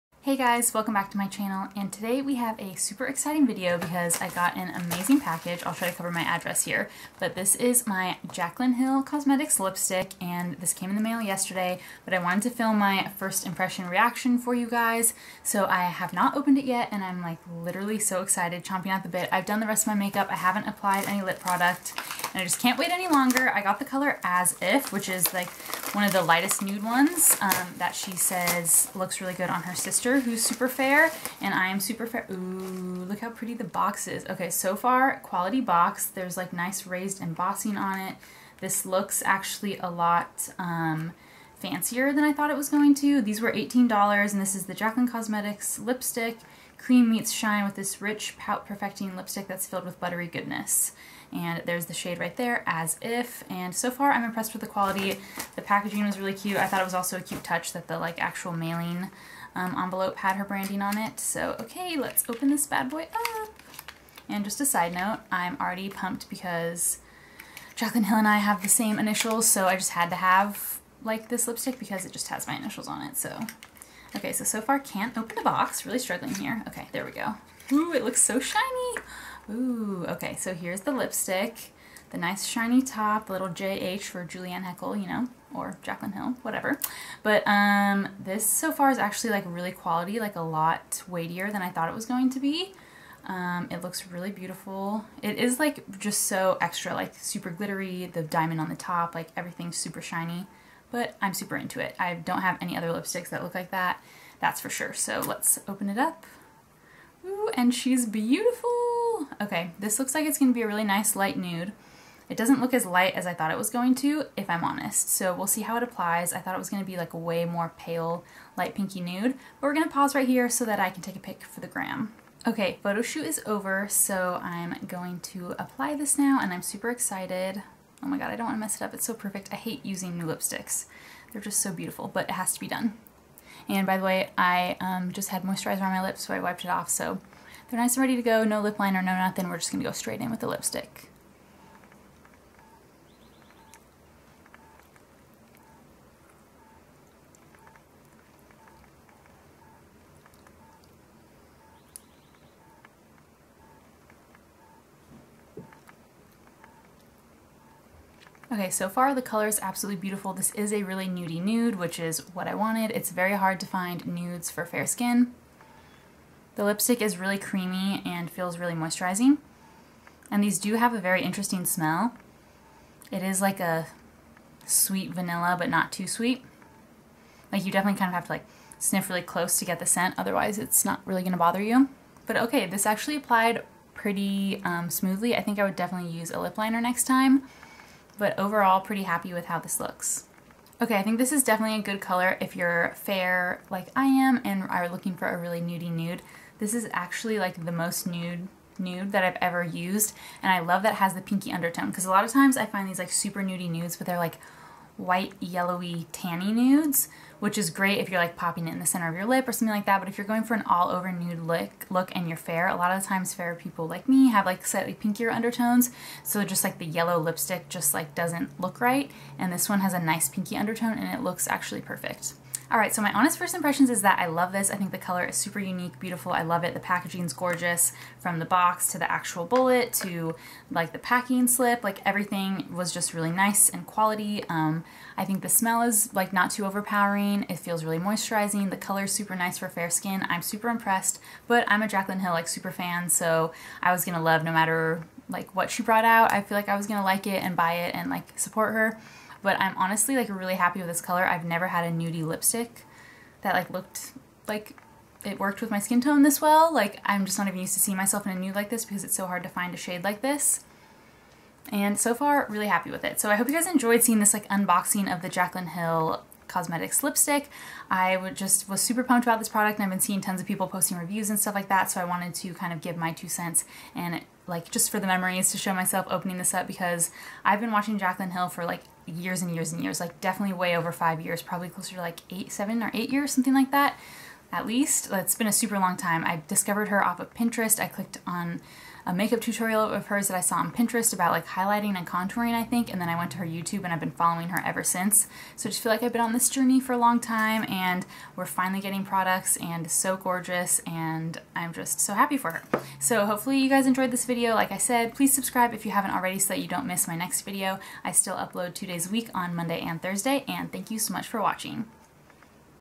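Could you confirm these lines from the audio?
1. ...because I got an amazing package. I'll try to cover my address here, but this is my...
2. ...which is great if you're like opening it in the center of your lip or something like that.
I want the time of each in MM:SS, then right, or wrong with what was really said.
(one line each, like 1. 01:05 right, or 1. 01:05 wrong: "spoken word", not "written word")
1. 00:03 right
2. 03:27 wrong: "popping", not "opening".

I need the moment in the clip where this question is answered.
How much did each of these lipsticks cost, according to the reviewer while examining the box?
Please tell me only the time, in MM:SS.
00:43.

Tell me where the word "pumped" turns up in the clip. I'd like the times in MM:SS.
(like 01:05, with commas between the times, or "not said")
01:05, 04:29.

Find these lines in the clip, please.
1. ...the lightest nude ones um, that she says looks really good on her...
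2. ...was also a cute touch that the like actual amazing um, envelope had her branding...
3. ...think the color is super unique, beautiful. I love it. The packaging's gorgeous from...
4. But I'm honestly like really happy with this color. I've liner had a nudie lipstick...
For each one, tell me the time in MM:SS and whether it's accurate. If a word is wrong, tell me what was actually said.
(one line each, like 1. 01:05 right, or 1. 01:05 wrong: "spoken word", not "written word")
1. 00:26 right
2. 00:56 wrong: "mailing", not "amazing"
3. 03:44 right
4. 04:09 wrong: "never", not "liner".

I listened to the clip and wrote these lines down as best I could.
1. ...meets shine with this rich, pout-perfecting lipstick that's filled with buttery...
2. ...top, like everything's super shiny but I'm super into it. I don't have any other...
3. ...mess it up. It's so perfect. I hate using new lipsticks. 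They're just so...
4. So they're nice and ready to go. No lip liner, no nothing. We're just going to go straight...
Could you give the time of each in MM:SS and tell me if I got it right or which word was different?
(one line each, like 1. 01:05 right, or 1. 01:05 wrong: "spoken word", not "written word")
1. 00:47 right
2. 01:38 right
3. 02:08 right
4. 02:16 right.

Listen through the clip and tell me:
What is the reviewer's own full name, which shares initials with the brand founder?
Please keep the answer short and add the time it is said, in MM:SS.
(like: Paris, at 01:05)
Julianne Heckel, at 01:24.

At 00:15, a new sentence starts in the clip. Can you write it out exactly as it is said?
So I have not opened it yet and I'm like literally so excited, chomping at the bit.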